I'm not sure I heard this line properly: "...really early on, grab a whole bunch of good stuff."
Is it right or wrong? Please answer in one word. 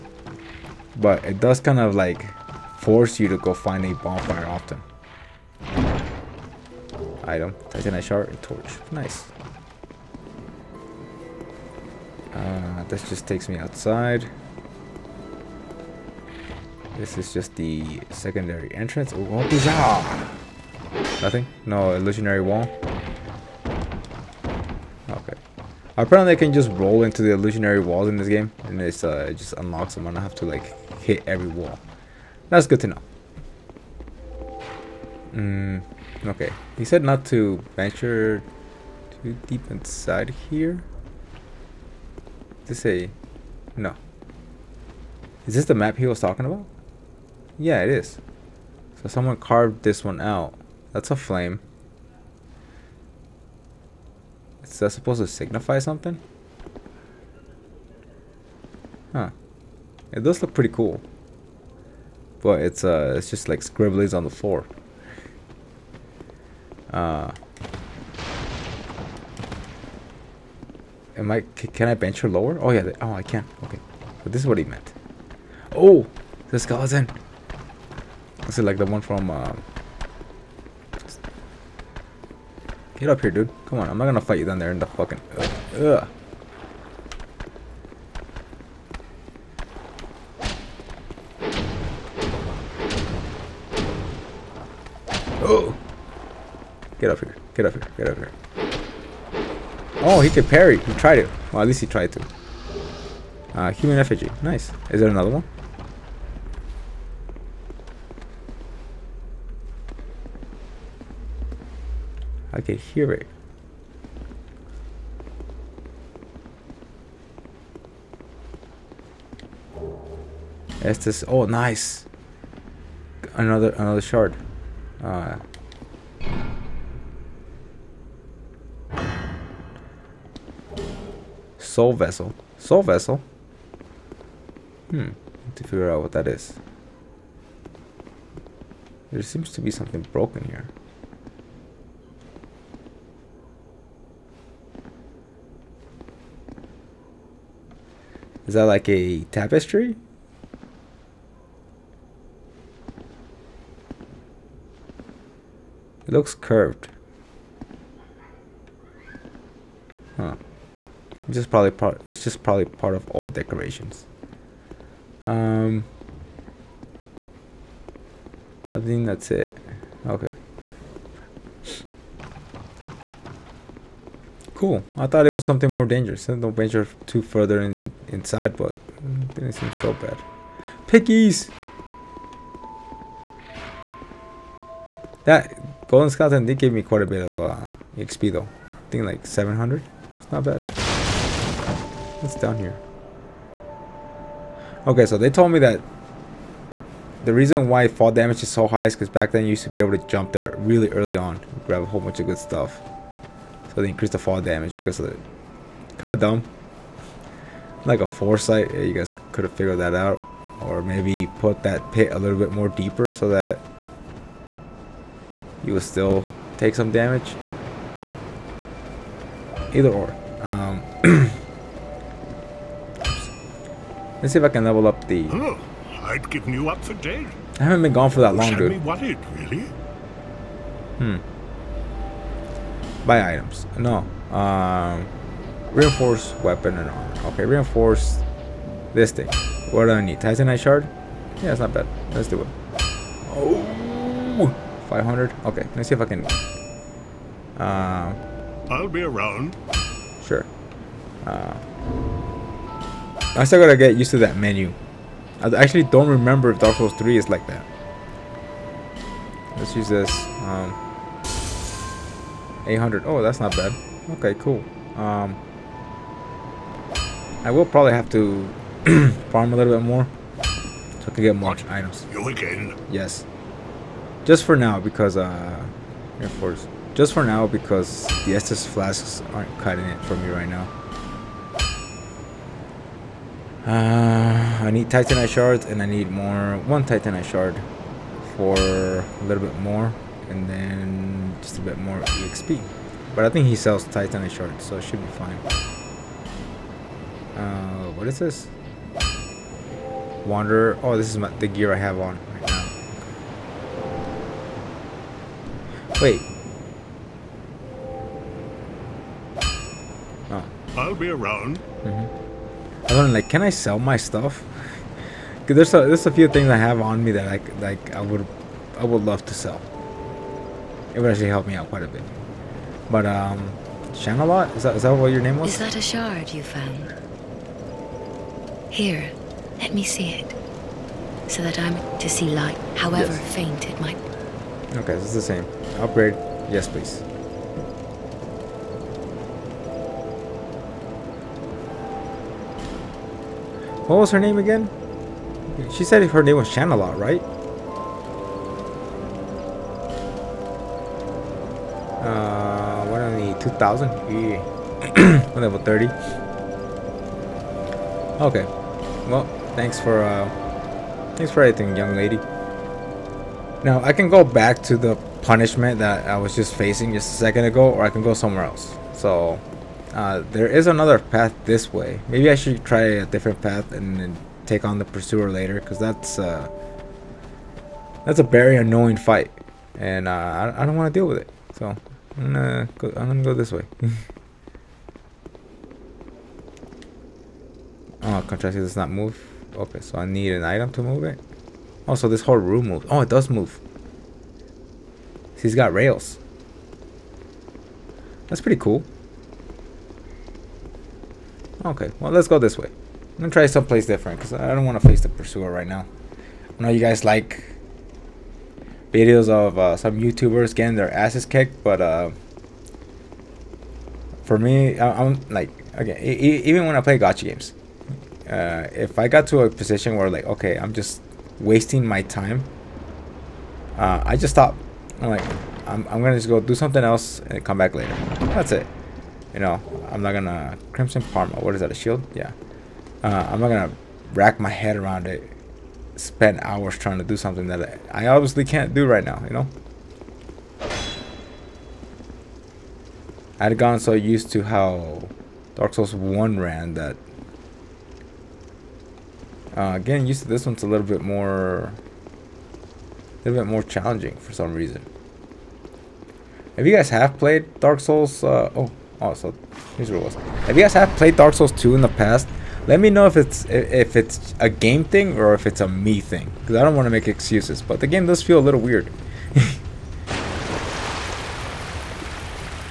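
right.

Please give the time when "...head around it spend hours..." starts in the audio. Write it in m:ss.
7:14.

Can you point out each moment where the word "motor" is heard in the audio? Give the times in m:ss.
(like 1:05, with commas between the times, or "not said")
not said.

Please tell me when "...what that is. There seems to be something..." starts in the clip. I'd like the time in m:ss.
2:16.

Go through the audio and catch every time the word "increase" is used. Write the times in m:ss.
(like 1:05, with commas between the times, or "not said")
3:23.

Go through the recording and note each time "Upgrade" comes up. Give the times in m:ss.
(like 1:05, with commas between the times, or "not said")
5:35.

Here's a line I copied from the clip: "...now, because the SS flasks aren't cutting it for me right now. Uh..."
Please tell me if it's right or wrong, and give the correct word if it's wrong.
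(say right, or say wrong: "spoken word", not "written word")
right.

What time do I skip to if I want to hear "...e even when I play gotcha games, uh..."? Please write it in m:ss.
6:55.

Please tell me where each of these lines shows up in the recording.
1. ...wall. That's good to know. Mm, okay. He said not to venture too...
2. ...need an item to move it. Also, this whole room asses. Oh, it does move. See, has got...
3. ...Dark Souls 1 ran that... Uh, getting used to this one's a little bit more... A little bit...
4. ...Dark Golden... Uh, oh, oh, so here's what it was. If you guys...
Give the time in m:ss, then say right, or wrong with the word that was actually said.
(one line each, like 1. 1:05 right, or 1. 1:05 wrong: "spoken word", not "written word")
1. 0:31 right
2. 6:30 wrong: "moves", not "asses"
3. 7:25 right
4. 7:37 wrong: "Souls", not "Golden".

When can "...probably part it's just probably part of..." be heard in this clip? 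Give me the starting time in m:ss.
2:41.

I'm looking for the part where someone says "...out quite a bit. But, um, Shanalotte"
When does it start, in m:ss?
5:21.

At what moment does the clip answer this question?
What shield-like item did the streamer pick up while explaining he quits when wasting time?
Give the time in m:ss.
7:10.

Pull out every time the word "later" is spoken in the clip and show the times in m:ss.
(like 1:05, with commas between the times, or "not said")
6:15, 7:07.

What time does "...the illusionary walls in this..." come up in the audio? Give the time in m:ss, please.
0:27.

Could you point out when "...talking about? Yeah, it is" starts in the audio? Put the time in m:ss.
0:46.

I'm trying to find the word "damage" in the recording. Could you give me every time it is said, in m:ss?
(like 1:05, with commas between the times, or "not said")
3:18, 3:24, 3:36.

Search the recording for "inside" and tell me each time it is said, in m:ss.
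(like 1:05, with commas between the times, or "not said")
0:39, 2:58.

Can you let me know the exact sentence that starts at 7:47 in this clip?
But the game does feel a little weird.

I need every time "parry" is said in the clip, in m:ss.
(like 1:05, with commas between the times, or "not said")
1:40.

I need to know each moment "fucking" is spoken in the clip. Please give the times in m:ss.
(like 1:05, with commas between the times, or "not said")
1:24.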